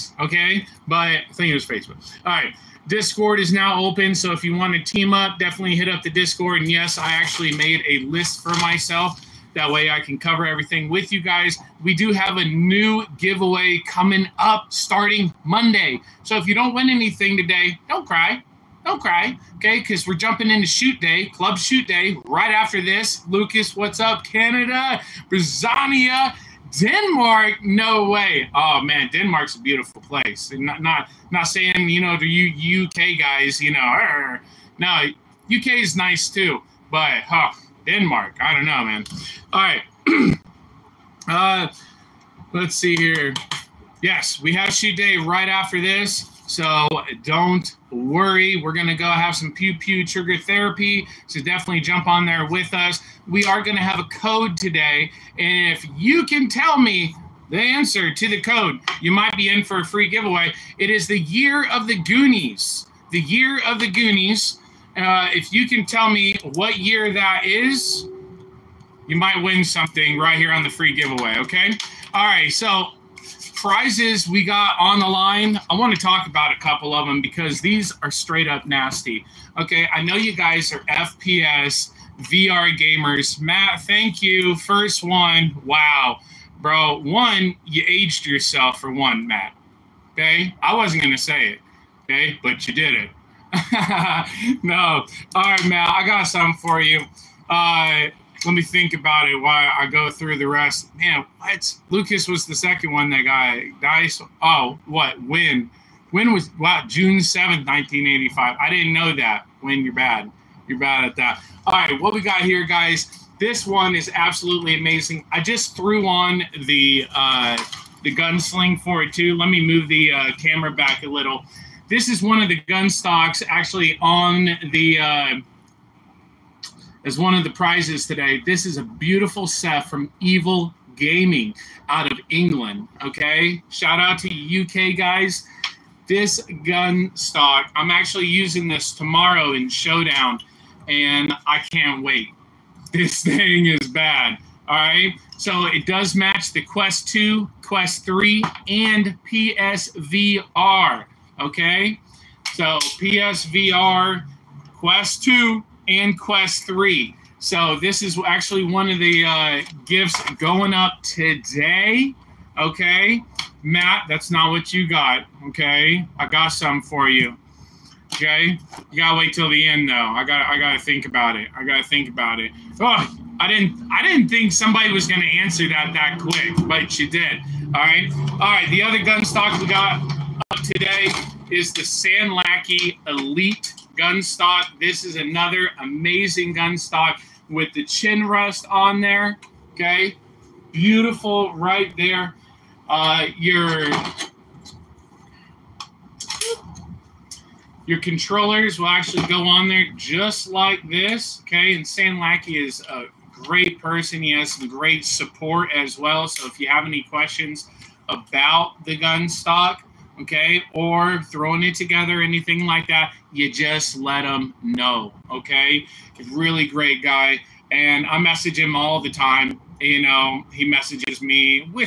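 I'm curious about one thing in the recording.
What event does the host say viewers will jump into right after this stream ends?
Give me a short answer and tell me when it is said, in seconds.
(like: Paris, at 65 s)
club shoot day, at 21 s.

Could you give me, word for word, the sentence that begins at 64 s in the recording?
Uh, if you can tell me what year that is, you might win something right here on the free giveaway.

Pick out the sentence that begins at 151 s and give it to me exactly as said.
Okay, so PSVR, Quest 2, and Quest 3.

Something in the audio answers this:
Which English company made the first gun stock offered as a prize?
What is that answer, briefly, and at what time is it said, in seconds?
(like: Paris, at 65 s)
Evil Gaming, at 130 s.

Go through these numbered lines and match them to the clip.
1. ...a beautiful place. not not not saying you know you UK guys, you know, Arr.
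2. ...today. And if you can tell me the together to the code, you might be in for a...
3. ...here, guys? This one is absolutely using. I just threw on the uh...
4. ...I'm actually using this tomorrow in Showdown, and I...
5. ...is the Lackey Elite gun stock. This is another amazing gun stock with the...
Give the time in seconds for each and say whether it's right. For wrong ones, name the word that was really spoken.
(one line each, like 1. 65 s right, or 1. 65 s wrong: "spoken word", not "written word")
1. 29 s right
2. 54 s wrong: "answer", not "together"
3. 112 s wrong: "amazing", not "using"
4. 137 s right
5. 181 s wrong: "Sanlacky", not "Lackey".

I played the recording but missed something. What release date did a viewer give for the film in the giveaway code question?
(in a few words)
June 7, 1985.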